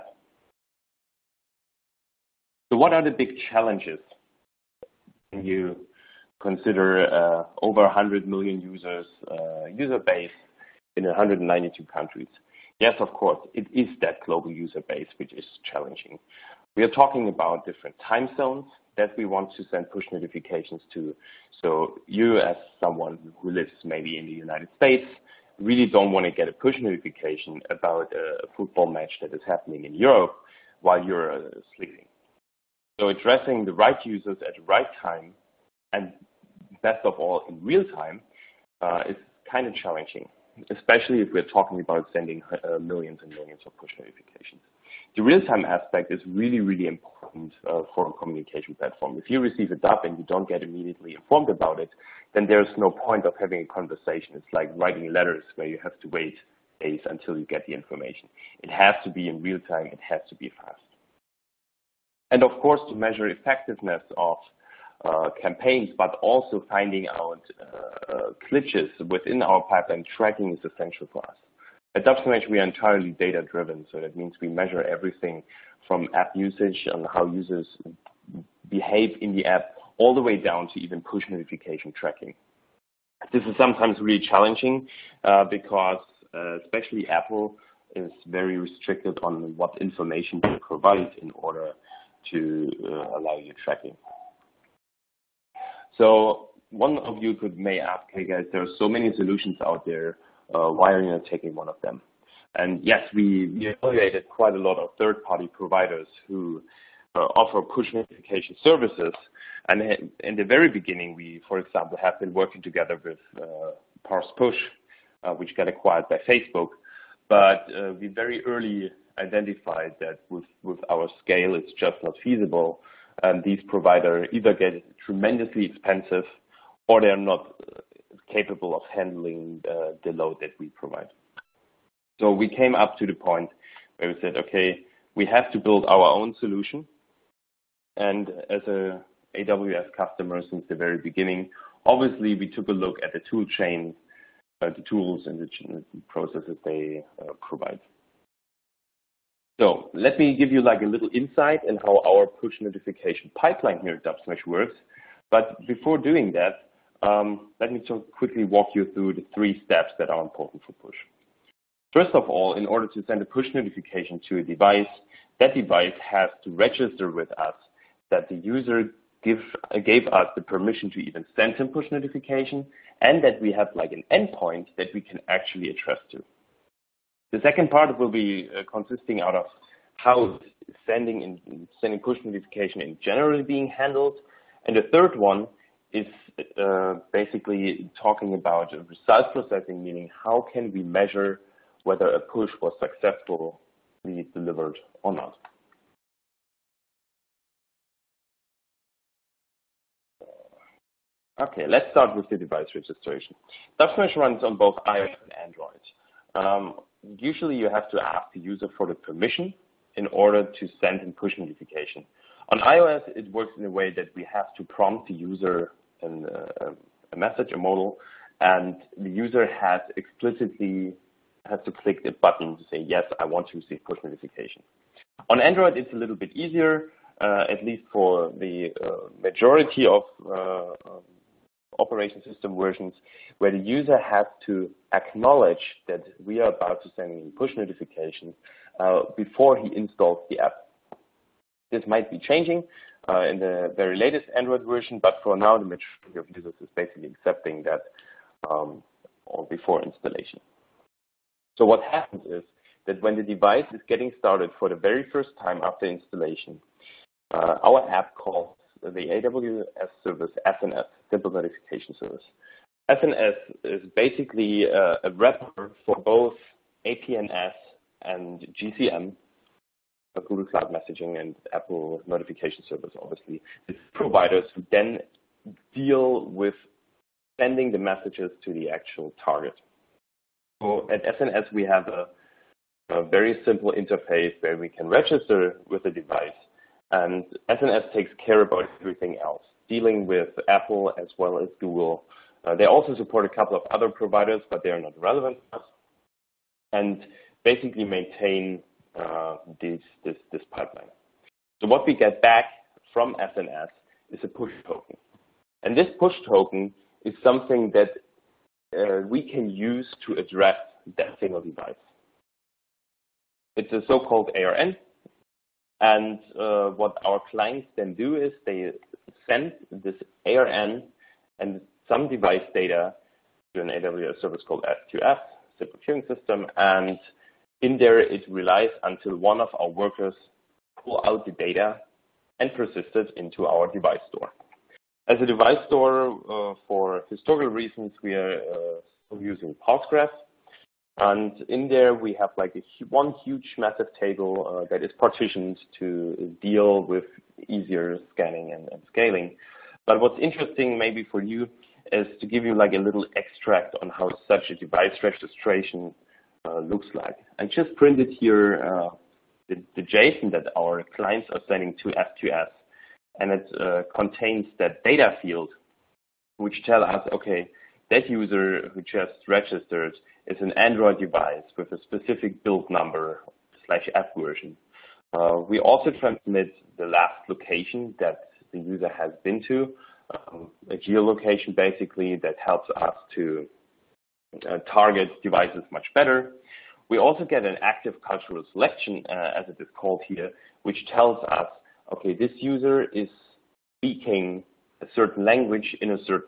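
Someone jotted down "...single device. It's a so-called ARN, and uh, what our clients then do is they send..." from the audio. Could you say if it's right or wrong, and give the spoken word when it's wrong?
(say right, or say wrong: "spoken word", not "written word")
right.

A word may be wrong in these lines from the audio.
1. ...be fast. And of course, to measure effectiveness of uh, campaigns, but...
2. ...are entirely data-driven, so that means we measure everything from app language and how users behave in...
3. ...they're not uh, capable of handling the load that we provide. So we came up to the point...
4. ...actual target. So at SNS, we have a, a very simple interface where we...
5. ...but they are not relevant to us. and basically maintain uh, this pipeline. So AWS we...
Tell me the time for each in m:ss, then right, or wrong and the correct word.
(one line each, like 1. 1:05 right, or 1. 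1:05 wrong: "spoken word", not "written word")
1. 1:00 right
2. 1:12 wrong: "usage", not "language"
3. 2:07 right
4. 4:38 right
5. 4:54 wrong: "What", not "AWS".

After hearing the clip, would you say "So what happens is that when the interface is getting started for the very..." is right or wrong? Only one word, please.
wrong.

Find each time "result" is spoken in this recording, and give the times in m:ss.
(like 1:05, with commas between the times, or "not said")
3:08.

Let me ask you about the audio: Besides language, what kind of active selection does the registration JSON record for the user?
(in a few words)
cultural.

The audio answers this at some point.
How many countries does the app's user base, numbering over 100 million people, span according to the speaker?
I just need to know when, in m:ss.
0:11.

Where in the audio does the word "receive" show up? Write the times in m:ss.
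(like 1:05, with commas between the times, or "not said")
0:49, 3:43.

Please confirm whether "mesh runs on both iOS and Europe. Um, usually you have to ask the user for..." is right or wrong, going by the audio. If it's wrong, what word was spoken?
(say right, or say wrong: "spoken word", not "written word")
wrong: "Android", not "Europe".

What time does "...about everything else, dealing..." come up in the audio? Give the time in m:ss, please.
4:48.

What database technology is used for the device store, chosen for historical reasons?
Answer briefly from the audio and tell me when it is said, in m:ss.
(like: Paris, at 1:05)
Postgres, at 5:39.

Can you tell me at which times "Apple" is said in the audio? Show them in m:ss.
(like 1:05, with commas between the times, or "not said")
1:27, 4:31, 4:50.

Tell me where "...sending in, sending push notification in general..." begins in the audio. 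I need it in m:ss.
3:00.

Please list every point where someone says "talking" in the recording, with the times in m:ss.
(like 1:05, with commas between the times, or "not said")
0:16, 0:41, 3:08.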